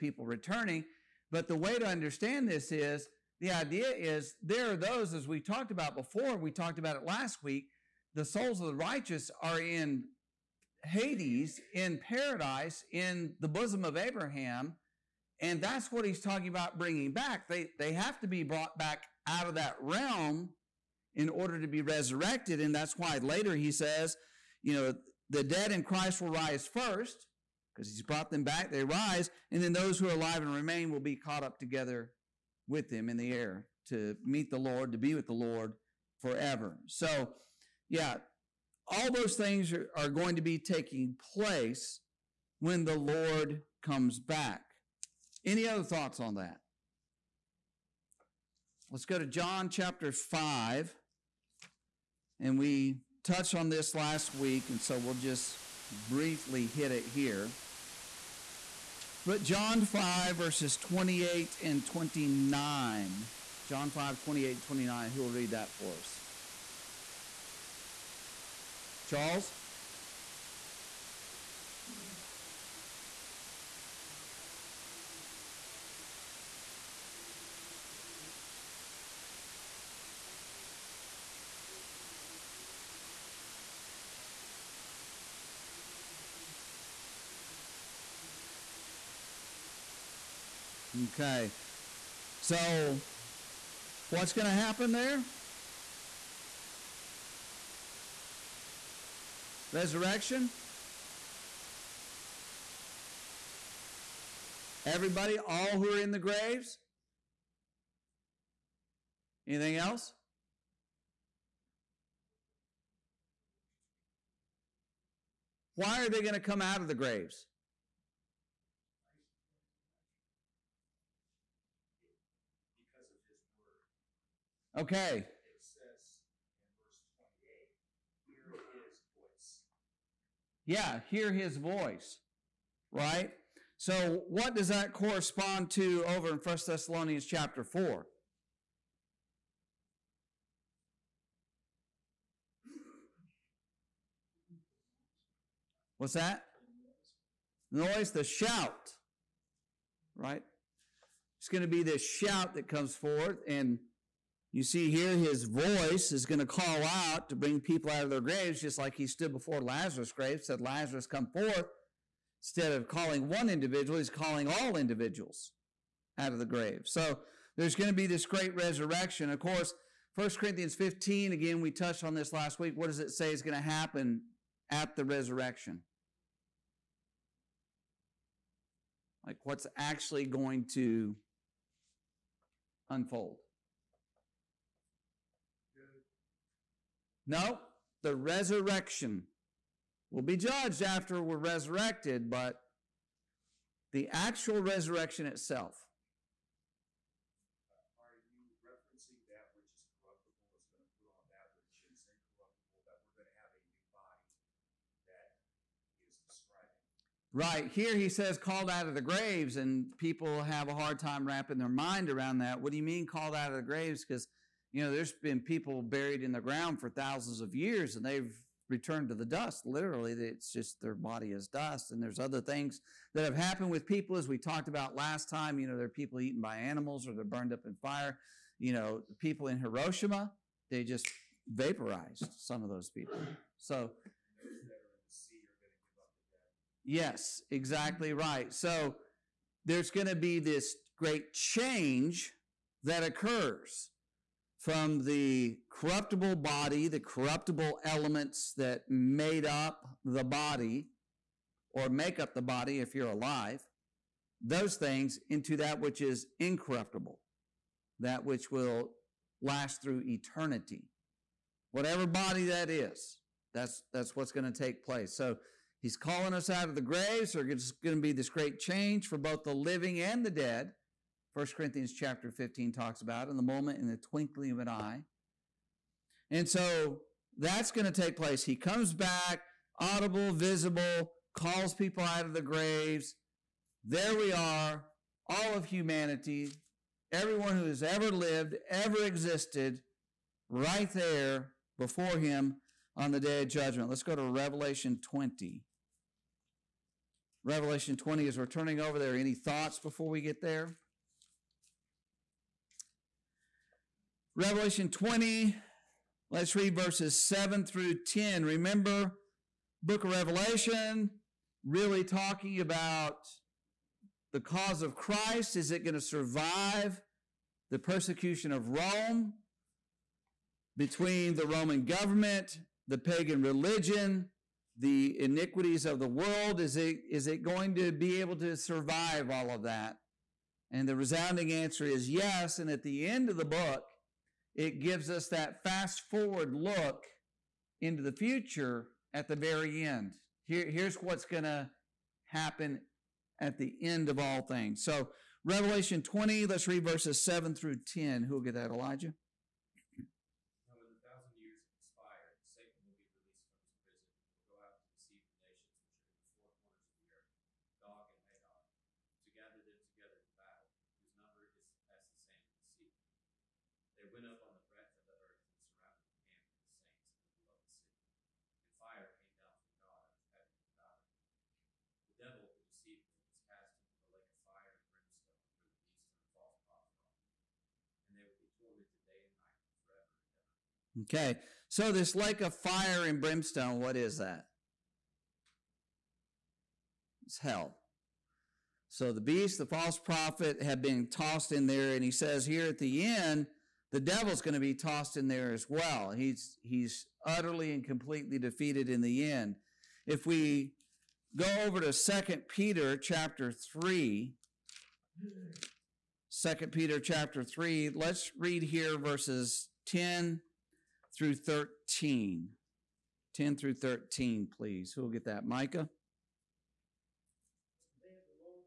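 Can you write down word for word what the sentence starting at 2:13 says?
So what does that correspond to over in 1 Thessalonians chapter 4?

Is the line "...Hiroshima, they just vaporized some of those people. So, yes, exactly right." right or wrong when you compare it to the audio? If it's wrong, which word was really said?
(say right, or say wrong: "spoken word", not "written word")
right.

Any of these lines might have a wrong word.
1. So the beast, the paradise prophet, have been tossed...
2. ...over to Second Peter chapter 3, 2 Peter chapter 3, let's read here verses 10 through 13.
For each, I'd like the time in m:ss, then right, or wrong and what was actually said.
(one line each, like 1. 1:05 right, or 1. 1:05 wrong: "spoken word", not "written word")
1. 6:28 wrong: "false", not "paradise"
2. 6:41 right.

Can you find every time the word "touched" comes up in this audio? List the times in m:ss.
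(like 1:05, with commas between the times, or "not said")
0:53, 2:51.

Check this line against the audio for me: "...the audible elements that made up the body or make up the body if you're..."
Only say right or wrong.
wrong.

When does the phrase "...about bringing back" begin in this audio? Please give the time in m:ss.
0:16.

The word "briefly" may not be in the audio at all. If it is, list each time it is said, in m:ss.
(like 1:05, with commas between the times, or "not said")
0:56.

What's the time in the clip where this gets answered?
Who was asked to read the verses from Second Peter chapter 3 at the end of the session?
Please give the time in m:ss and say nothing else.
6:55.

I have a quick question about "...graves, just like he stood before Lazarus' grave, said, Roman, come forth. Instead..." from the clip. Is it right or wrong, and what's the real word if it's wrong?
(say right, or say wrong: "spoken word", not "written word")
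wrong: "Lazarus", not "Roman".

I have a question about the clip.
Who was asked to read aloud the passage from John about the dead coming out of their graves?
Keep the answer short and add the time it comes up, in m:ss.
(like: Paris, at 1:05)
Charles, at 1:09.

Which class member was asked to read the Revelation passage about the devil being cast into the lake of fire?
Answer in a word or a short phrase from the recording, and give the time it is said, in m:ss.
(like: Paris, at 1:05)
Elijah, at 5:48.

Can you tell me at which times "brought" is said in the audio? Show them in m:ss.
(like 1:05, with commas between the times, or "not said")
0:18, 0:28.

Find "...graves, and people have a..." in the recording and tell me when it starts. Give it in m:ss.
3:29.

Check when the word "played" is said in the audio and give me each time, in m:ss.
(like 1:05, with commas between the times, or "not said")
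not said.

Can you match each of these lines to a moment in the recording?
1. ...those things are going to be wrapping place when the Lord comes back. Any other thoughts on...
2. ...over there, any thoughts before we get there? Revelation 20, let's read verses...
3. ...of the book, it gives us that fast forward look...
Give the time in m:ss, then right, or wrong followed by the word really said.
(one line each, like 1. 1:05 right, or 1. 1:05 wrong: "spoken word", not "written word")
1. 0:39 wrong: "taking", not "wrapping"
2. 4:58 right
3. 5:33 right.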